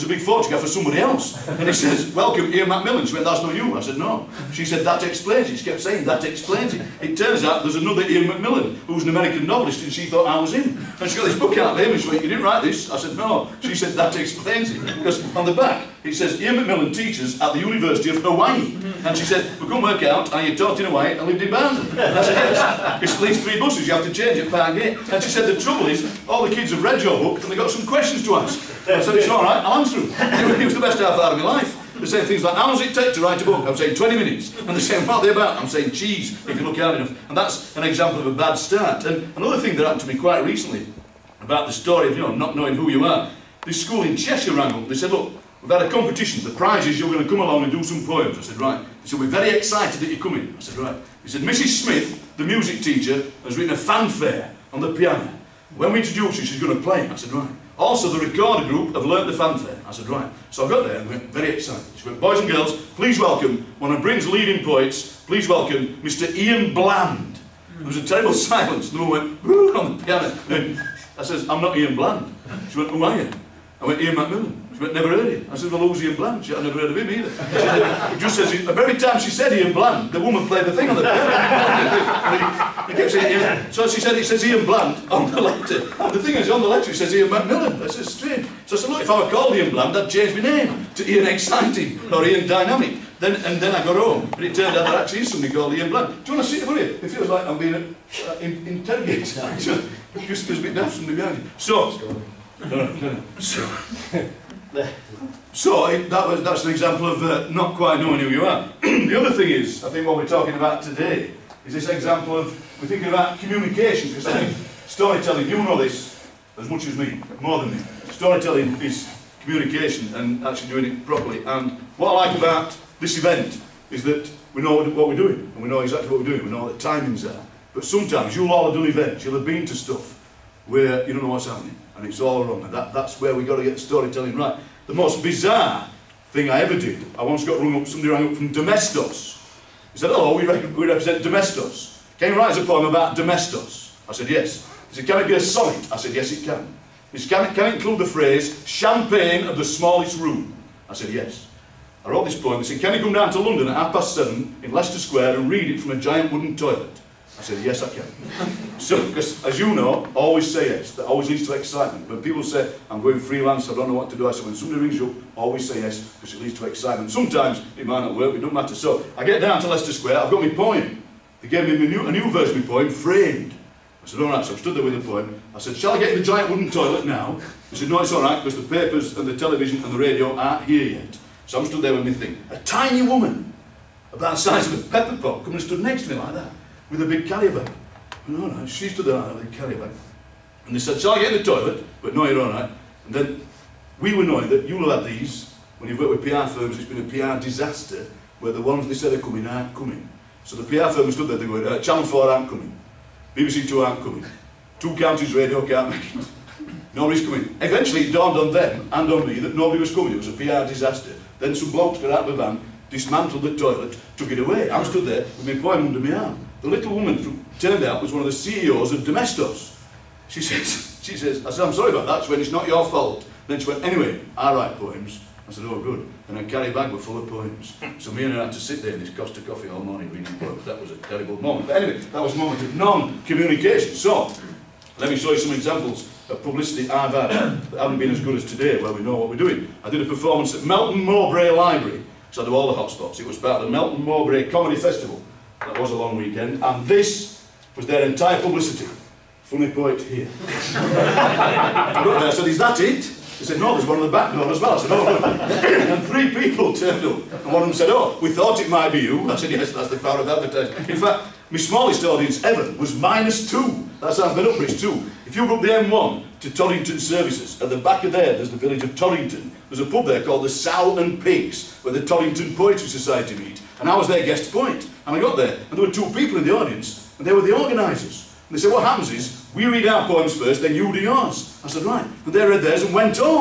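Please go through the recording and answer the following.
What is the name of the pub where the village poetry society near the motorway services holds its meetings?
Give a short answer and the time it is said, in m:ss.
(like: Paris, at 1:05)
Sow and Pigs, at 4:30.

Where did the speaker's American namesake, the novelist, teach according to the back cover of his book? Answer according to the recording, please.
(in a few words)
University of Hawaii.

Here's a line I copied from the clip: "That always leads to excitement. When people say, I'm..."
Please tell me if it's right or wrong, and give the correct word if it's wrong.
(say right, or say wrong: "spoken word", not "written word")
right.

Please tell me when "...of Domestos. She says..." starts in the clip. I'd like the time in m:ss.
3:38.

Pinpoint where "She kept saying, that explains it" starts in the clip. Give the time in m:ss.
0:05.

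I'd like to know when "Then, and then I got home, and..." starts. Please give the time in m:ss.
1:33.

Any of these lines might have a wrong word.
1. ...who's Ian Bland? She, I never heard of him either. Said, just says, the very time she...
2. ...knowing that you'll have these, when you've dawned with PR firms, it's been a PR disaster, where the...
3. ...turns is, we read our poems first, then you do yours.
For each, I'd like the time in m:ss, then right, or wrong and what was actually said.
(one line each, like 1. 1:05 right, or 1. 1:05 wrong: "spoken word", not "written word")
1. 1:15 right
2. 3:14 wrong: "worked", not "dawned"
3. 4:38 wrong: "happens", not "turns".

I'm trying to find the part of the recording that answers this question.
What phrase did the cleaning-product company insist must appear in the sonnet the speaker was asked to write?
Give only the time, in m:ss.
2:28.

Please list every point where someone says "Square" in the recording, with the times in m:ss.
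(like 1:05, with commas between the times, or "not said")
2:34, 2:49.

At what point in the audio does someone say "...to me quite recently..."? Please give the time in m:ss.
0:40.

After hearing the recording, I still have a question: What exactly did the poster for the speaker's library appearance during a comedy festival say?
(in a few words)
Funny poet here.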